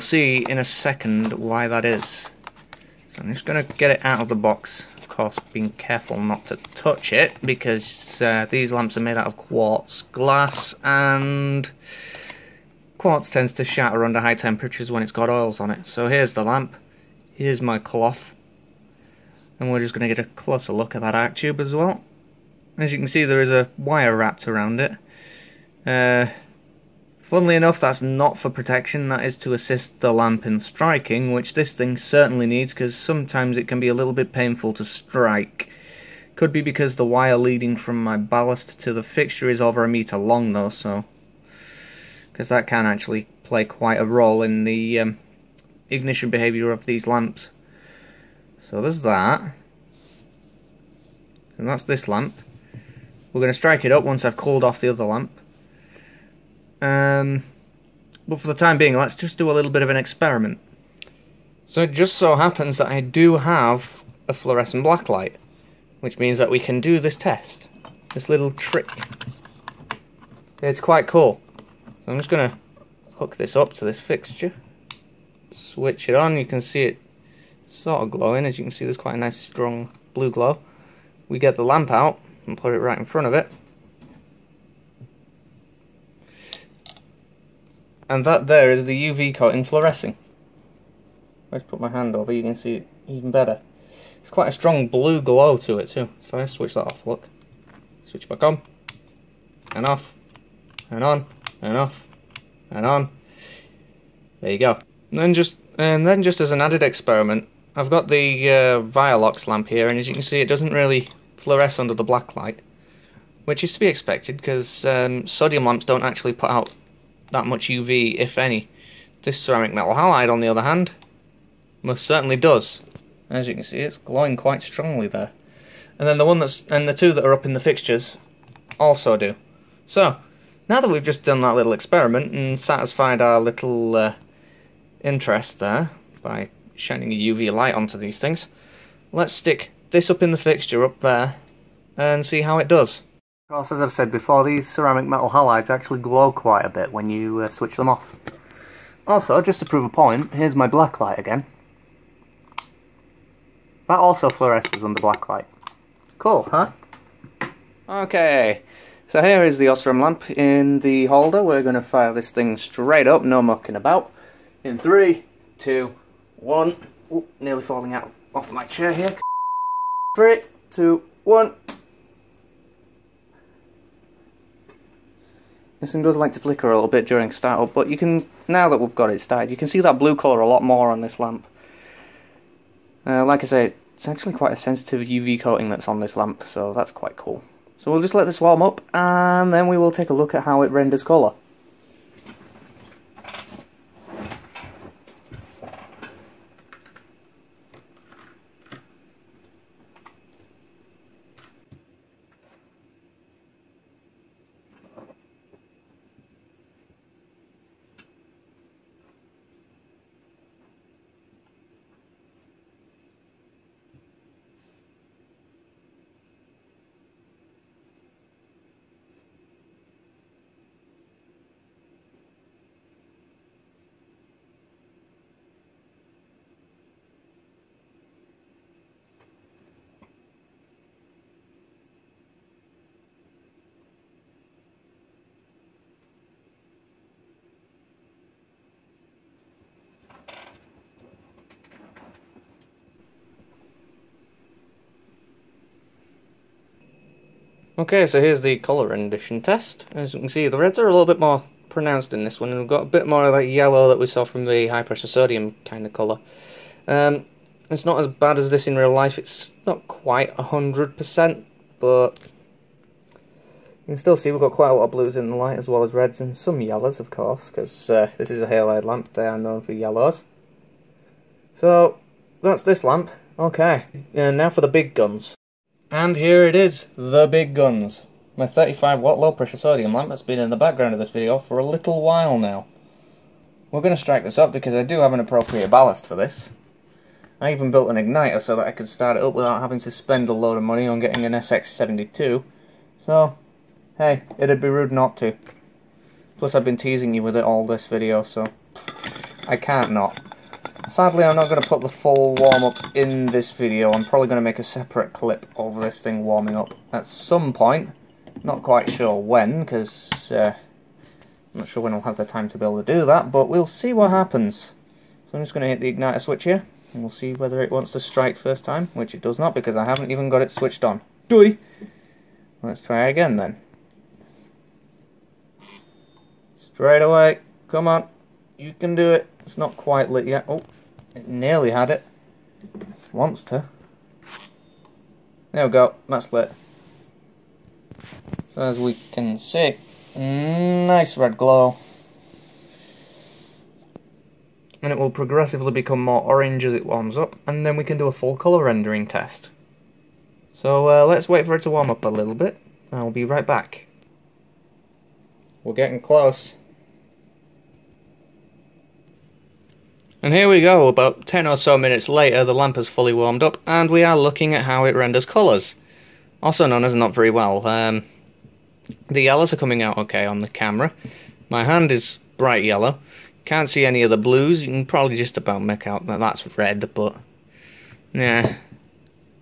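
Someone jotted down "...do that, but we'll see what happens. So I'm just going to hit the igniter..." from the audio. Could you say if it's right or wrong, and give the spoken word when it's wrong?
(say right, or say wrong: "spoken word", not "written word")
right.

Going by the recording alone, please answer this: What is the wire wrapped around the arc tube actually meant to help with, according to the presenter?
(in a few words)
striking.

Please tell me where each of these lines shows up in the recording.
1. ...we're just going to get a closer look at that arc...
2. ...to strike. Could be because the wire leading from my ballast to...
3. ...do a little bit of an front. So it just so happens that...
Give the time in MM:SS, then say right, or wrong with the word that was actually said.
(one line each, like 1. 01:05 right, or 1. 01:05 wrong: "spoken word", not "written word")
1. 00:19 right
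2. 00:34 right
3. 00:59 wrong: "experiment", not "front".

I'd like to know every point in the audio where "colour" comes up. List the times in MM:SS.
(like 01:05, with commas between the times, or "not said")
03:00, 03:11, 04:08, 04:15, 05:48, 06:05.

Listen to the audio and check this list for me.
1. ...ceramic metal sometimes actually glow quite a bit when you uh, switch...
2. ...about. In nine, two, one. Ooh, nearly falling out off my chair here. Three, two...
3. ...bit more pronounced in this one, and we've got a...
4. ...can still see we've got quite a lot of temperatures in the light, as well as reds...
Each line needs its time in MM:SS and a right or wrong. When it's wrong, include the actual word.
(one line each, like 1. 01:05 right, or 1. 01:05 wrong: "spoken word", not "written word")
1. 02:24 wrong: "halides", not "sometimes"
2. 02:43 wrong: "three", not "nine"
3. 04:11 right
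4. 04:23 wrong: "blues", not "temperatures".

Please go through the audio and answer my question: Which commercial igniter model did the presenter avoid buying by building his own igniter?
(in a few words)
SX72.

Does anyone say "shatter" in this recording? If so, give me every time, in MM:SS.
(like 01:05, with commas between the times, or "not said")
00:13.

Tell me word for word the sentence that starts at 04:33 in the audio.
Okay, and now for the big guns.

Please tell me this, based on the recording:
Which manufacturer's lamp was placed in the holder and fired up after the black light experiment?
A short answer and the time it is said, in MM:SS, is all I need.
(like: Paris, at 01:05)
Osram, at 02:39.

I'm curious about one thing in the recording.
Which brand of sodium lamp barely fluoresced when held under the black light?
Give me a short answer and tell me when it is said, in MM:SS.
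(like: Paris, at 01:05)
Vialox, at 01:48.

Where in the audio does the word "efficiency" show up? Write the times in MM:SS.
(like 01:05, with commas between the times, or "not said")
not said.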